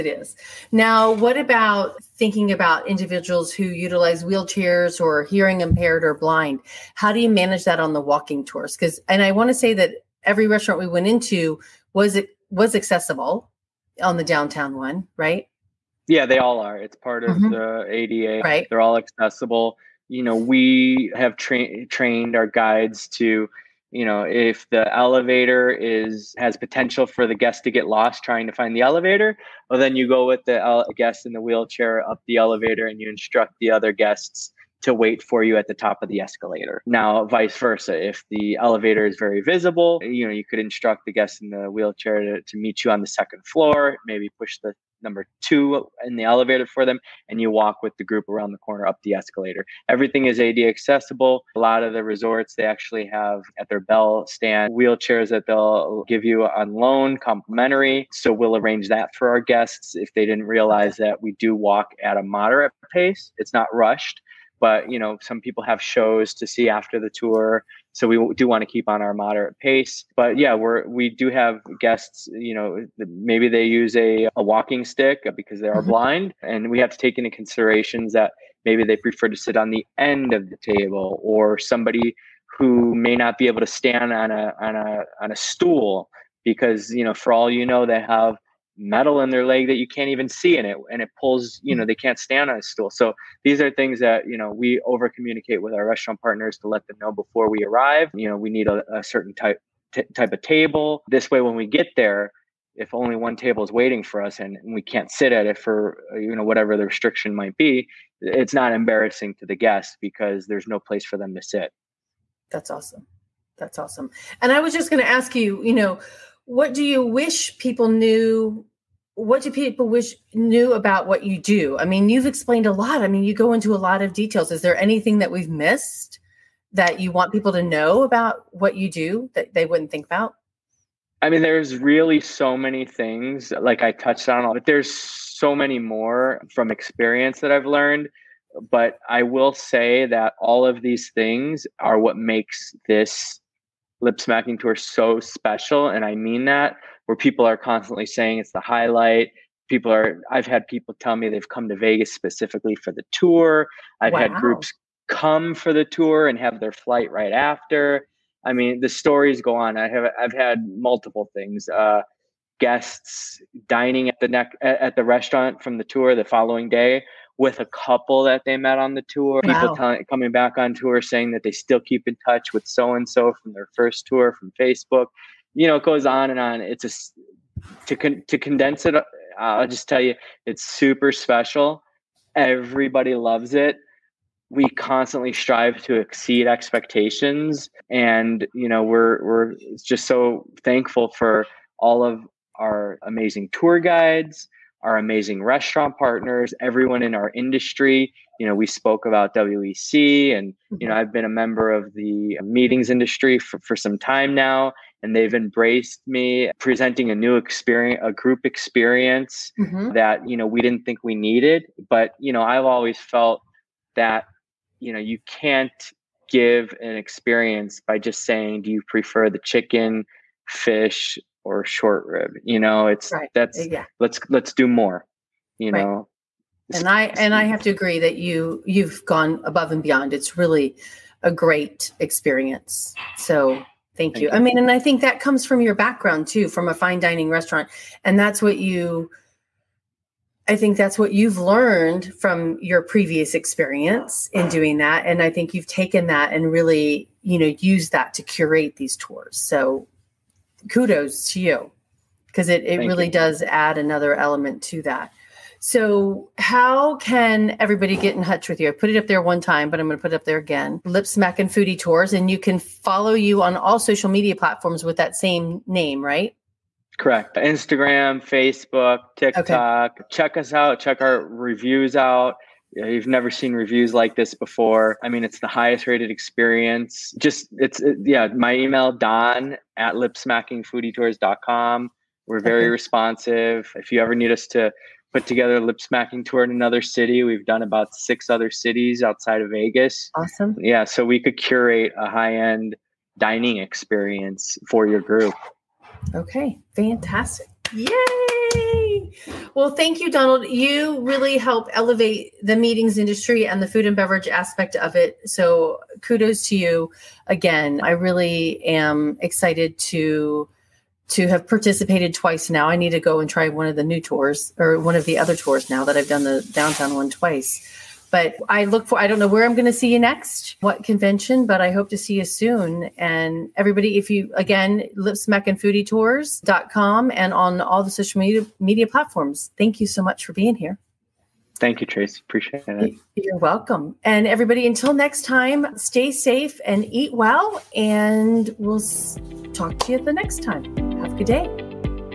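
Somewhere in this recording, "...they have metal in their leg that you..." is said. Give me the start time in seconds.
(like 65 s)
87 s.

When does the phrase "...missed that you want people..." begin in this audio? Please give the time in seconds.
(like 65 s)
125 s.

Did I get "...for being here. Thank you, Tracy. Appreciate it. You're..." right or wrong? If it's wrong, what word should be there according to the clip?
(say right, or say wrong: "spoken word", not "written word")
right.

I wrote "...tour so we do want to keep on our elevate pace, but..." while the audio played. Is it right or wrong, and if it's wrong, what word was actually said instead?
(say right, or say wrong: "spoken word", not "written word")
wrong: "moderate", not "elevate".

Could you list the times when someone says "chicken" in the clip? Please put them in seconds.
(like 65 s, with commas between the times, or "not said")
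219 s.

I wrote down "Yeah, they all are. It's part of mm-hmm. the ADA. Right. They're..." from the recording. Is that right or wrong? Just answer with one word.
right.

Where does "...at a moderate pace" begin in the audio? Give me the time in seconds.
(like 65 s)
62 s.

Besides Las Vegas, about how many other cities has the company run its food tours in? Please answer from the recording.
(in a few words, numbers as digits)
6.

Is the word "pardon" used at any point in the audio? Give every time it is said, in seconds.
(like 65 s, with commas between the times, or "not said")
not said.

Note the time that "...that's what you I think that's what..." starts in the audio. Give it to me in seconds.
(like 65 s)
238 s.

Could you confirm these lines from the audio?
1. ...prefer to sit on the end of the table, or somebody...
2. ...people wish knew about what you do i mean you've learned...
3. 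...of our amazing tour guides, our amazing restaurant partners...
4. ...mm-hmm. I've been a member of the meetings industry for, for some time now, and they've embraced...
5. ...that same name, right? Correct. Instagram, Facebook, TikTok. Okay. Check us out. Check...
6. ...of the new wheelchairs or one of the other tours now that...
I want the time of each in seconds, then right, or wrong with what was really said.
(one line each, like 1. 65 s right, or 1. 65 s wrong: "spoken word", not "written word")
1. 78 s right
2. 119 s wrong: "explained", not "learned"
3. 192 s right
4. 200 s right
5. 264 s right
6. 313 s wrong: "tours", not "wheelchairs".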